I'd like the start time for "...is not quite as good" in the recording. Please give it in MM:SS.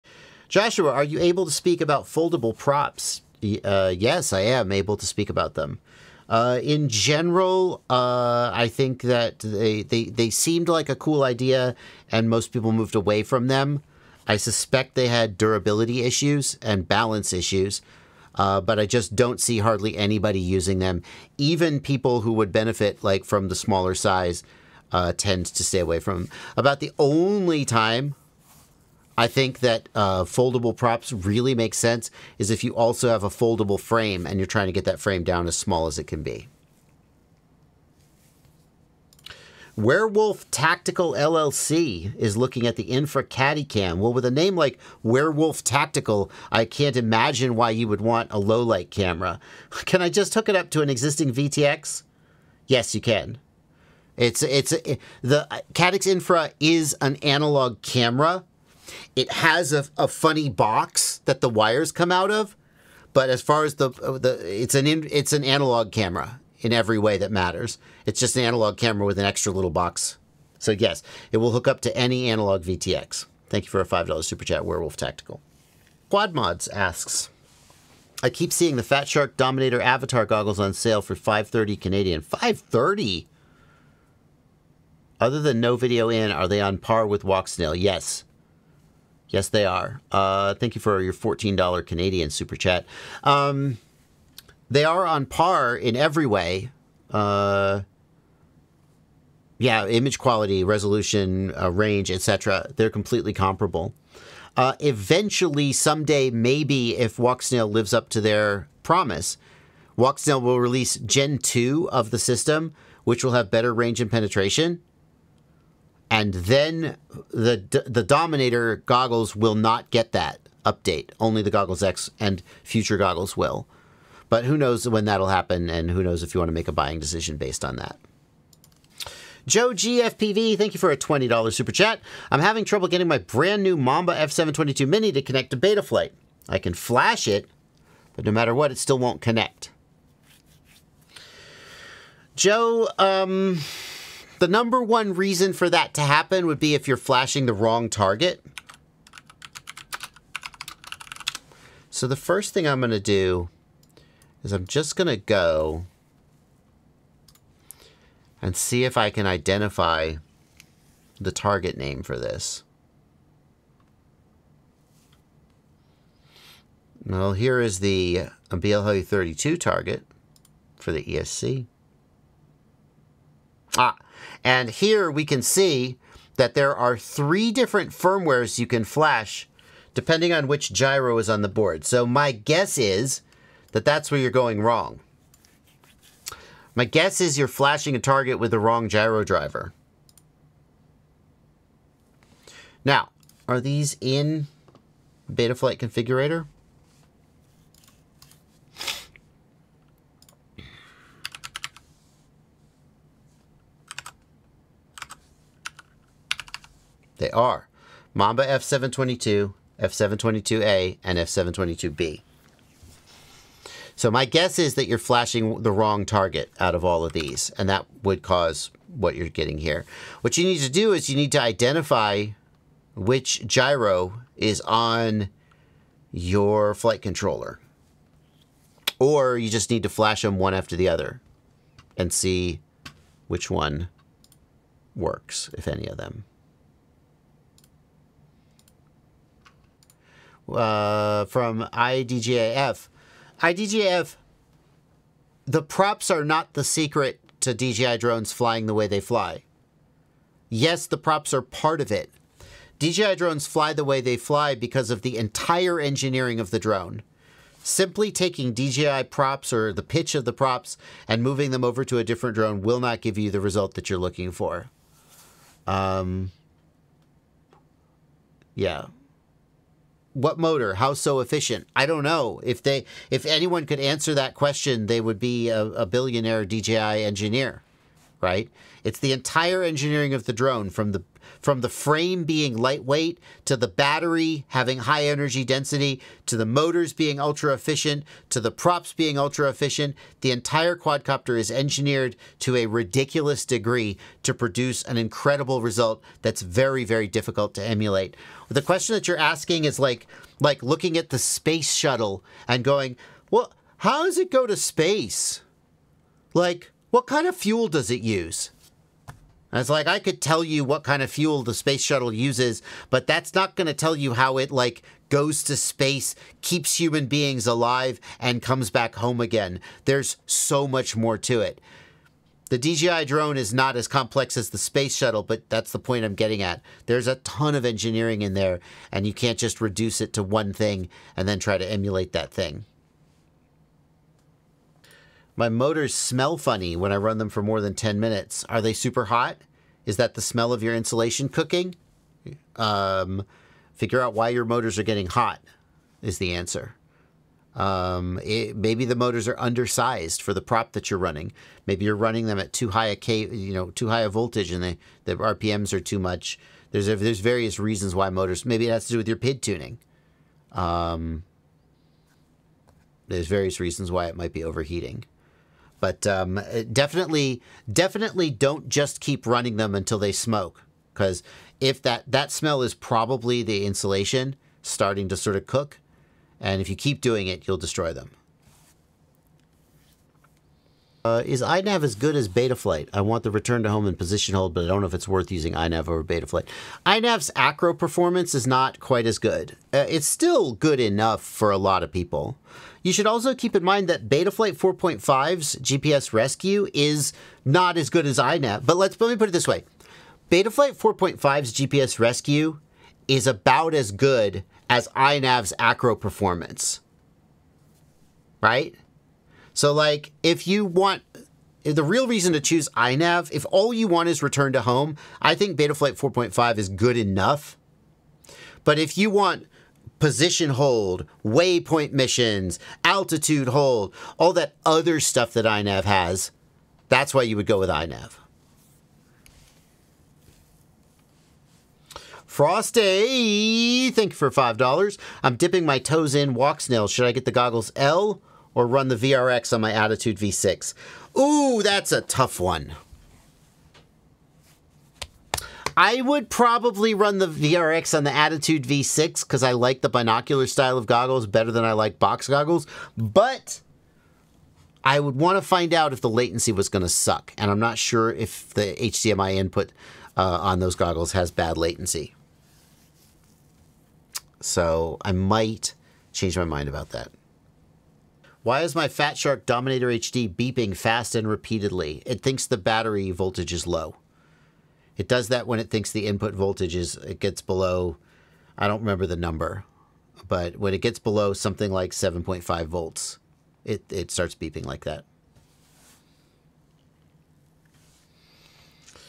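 06:28.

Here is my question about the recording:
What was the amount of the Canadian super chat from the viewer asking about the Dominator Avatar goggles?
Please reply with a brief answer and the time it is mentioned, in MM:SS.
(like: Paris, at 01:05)
$14, at 01:31.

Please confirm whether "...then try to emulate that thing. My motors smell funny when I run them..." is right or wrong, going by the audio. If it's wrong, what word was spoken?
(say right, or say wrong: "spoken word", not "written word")
right.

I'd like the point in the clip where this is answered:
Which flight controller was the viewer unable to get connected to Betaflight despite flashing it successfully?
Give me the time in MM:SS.
02:13.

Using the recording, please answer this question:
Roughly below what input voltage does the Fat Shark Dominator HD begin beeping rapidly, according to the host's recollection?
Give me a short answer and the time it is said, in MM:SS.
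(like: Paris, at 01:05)
7.5 volts, at 08:01.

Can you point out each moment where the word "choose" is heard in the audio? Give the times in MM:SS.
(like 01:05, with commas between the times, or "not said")
06:52.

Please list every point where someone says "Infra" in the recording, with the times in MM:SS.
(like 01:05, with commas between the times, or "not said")
00:42, 00:56.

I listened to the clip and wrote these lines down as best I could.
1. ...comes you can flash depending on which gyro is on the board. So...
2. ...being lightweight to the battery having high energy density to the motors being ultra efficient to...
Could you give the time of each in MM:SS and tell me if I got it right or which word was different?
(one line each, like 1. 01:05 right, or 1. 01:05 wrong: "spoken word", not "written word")
1. 02:57 wrong: "firmwares", not "comes"
2. 04:42 right.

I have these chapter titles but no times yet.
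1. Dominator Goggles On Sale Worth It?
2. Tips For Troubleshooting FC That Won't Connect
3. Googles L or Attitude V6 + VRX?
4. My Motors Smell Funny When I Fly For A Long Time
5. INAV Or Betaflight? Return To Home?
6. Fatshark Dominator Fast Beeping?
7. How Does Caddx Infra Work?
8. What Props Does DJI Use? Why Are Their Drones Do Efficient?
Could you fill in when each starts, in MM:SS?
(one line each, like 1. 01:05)
1. 01:16
2. 02:08
3. 07:11
4. 05:34
5. 06:20
6. 07:47
7. 00:37
8. 03:59.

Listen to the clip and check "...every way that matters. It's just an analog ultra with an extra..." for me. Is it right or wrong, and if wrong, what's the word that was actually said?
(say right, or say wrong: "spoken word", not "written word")
wrong: "camera", not "ultra".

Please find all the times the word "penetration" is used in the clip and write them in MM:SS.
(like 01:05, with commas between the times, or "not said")
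01:54.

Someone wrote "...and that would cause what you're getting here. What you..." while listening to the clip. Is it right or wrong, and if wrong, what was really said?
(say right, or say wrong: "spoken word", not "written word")
right.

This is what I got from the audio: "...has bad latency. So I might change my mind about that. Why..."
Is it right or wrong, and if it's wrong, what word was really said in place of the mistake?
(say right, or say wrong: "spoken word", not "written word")
right.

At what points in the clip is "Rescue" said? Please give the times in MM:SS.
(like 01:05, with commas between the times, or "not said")
06:36, 06:41.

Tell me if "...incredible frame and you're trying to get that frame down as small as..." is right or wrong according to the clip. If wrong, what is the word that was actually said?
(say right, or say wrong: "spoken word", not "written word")
wrong: "foldable", not "incredible".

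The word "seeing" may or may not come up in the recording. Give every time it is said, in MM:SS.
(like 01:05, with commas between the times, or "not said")
01:18.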